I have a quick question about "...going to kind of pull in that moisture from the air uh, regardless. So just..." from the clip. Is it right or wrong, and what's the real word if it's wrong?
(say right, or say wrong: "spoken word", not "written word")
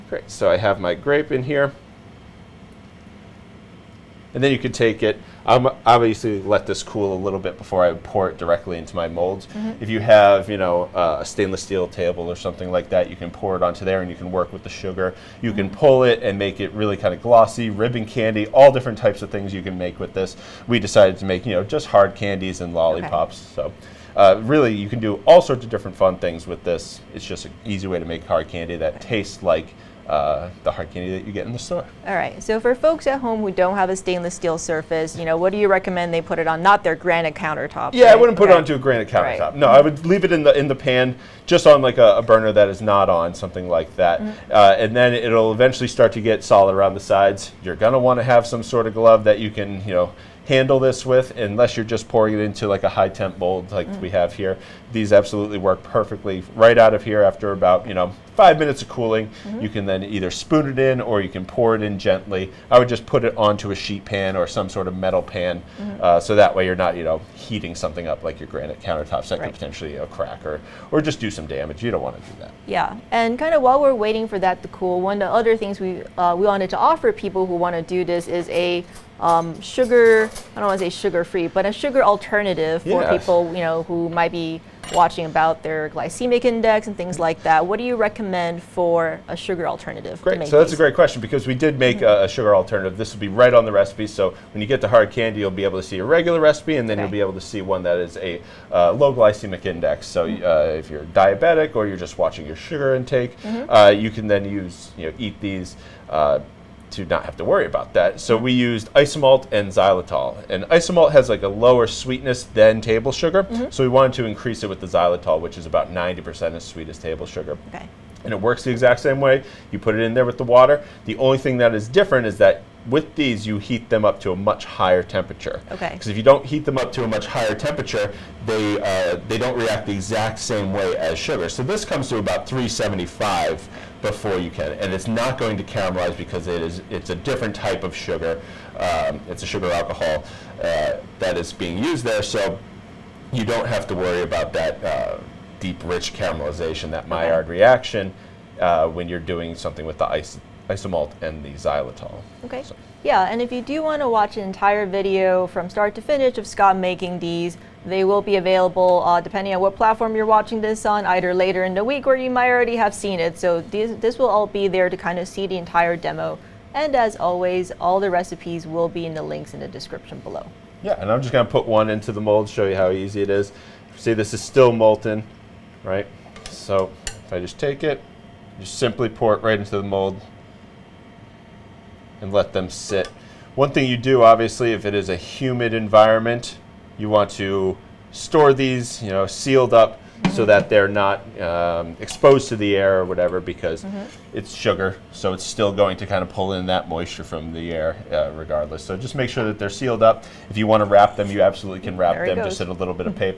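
right.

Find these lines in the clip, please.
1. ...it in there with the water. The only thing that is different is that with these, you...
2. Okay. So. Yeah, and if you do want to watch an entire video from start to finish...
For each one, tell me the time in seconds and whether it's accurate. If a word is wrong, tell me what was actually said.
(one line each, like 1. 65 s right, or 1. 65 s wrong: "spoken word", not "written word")
1. 119 s right
2. 152 s right.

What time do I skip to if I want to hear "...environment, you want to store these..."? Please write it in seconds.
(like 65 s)
185 s.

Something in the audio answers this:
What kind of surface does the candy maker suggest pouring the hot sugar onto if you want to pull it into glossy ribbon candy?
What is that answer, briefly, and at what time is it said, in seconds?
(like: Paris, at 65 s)
stainless steel table, at 11 s.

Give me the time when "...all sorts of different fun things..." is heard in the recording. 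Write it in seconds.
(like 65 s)
25 s.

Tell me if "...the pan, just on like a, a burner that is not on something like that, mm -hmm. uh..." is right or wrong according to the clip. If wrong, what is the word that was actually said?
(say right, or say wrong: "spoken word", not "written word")
right.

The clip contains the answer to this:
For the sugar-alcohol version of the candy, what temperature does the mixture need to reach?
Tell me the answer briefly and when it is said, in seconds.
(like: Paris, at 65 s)
375, at 132 s.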